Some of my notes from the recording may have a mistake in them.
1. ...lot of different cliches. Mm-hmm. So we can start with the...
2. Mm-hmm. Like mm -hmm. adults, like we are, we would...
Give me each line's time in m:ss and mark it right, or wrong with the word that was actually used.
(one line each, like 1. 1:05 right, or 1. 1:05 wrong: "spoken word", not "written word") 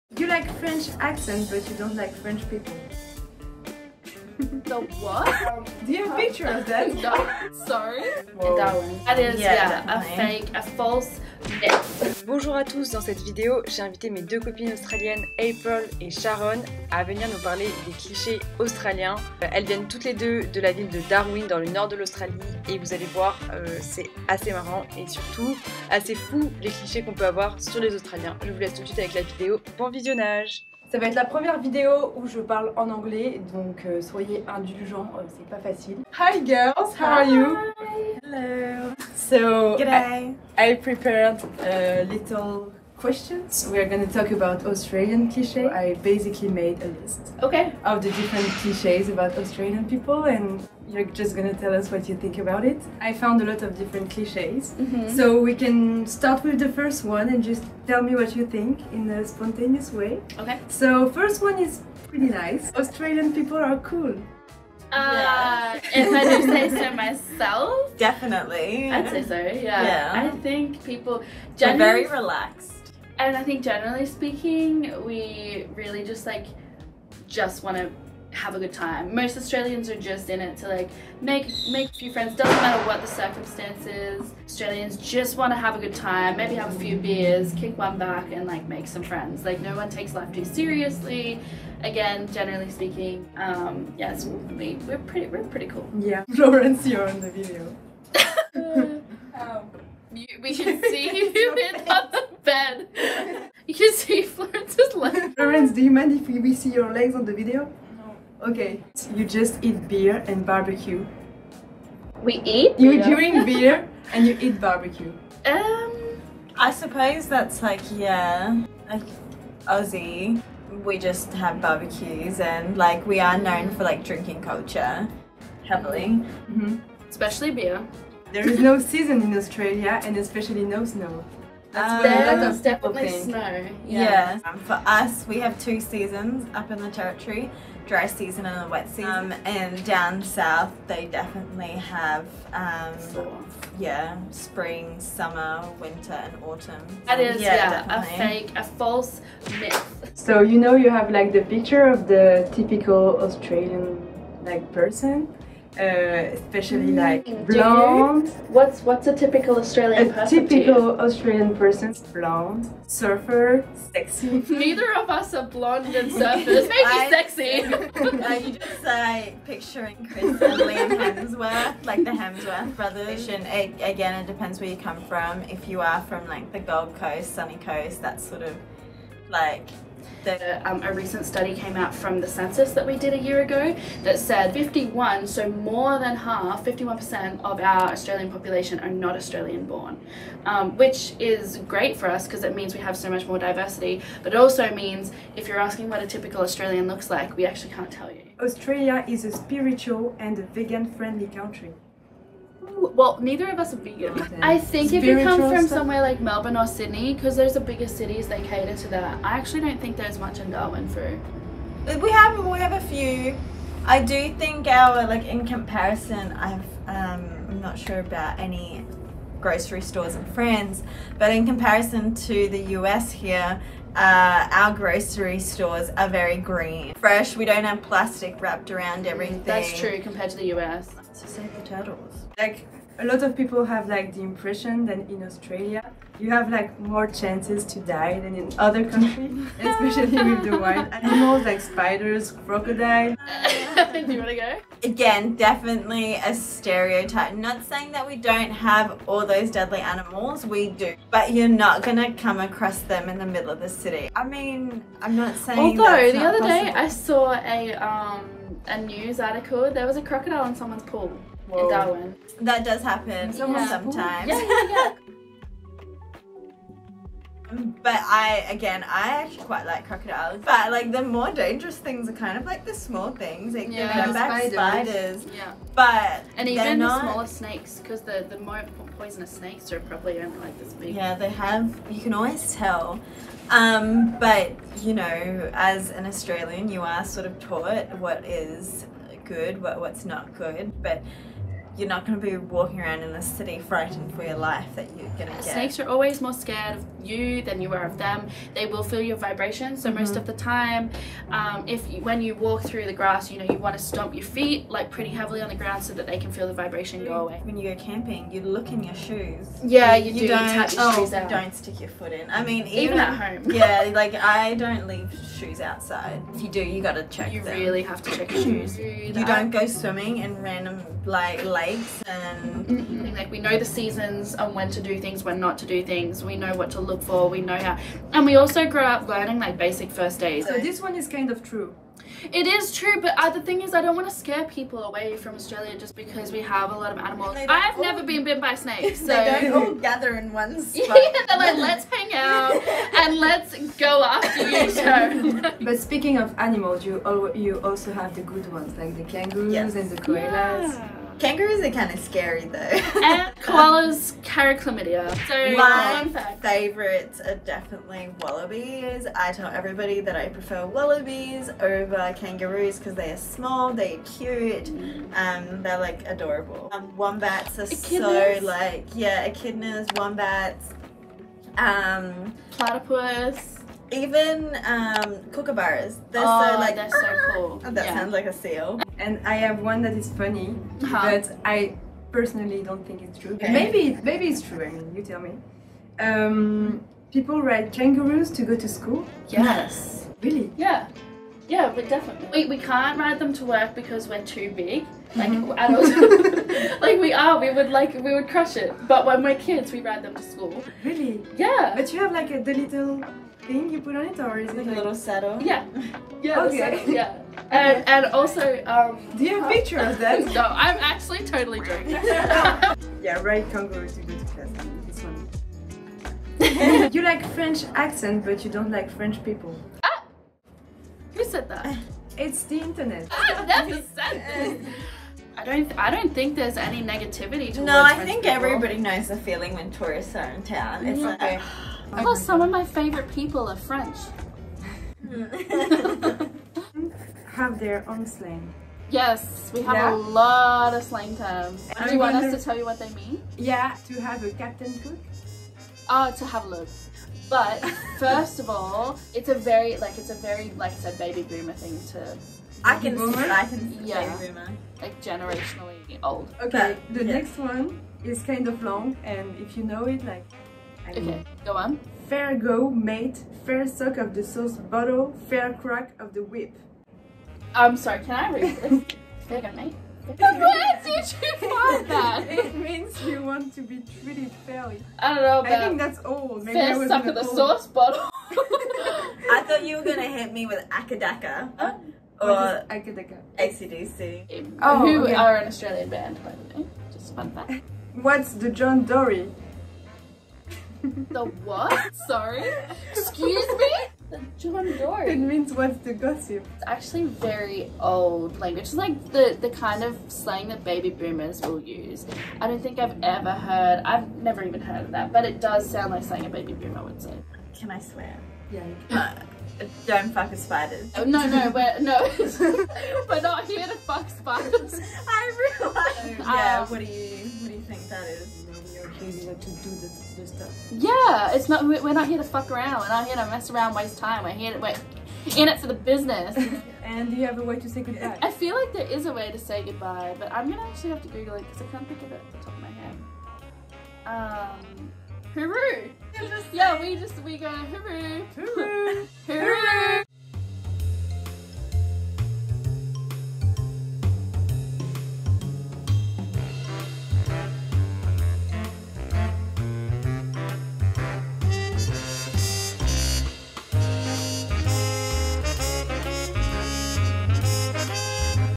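1. 0:53 right
2. 6:34 right.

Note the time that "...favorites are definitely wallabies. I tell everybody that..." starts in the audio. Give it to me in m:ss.
5:56.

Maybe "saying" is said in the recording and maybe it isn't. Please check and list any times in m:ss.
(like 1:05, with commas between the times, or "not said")
4:07, 4:15.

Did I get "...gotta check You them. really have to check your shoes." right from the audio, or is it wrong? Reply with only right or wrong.
right.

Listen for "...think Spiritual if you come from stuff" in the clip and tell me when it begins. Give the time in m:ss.
3:24.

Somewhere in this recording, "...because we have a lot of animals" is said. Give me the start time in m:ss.
5:35.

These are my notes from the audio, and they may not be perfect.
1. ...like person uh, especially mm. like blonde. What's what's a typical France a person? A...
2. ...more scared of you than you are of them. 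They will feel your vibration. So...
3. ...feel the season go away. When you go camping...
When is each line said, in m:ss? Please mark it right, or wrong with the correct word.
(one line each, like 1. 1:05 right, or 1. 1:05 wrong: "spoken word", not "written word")
1. 2:34 wrong: "Australian", not "France"
2. 4:56 right
3. 5:06 wrong: "vibration", not "season".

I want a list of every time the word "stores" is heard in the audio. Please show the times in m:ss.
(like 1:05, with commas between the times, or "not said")
3:39, 3:45.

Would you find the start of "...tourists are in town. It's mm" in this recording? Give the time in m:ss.
7:09.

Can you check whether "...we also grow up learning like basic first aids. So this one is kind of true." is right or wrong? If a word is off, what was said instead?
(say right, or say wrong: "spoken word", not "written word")
right.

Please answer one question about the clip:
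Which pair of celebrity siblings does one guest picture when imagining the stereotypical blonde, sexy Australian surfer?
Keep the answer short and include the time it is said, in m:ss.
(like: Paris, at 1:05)
Hemsworth brothers, at 2:52.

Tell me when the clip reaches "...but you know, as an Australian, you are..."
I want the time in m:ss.
4:44.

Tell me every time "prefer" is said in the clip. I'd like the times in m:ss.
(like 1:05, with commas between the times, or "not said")
6:00.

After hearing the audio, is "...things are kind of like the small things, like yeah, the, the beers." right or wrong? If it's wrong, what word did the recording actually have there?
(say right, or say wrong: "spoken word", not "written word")
wrong: "spiders", not "beers".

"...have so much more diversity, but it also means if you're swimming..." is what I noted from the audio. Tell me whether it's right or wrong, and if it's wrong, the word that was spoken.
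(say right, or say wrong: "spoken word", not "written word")
wrong: "asking", not "swimming".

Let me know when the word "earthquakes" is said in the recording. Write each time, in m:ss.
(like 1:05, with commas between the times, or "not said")
not said.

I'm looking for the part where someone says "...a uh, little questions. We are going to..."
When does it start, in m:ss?
0:41.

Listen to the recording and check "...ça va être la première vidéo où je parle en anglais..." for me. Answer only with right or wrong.
right.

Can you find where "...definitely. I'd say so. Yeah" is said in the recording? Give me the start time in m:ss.
1:07.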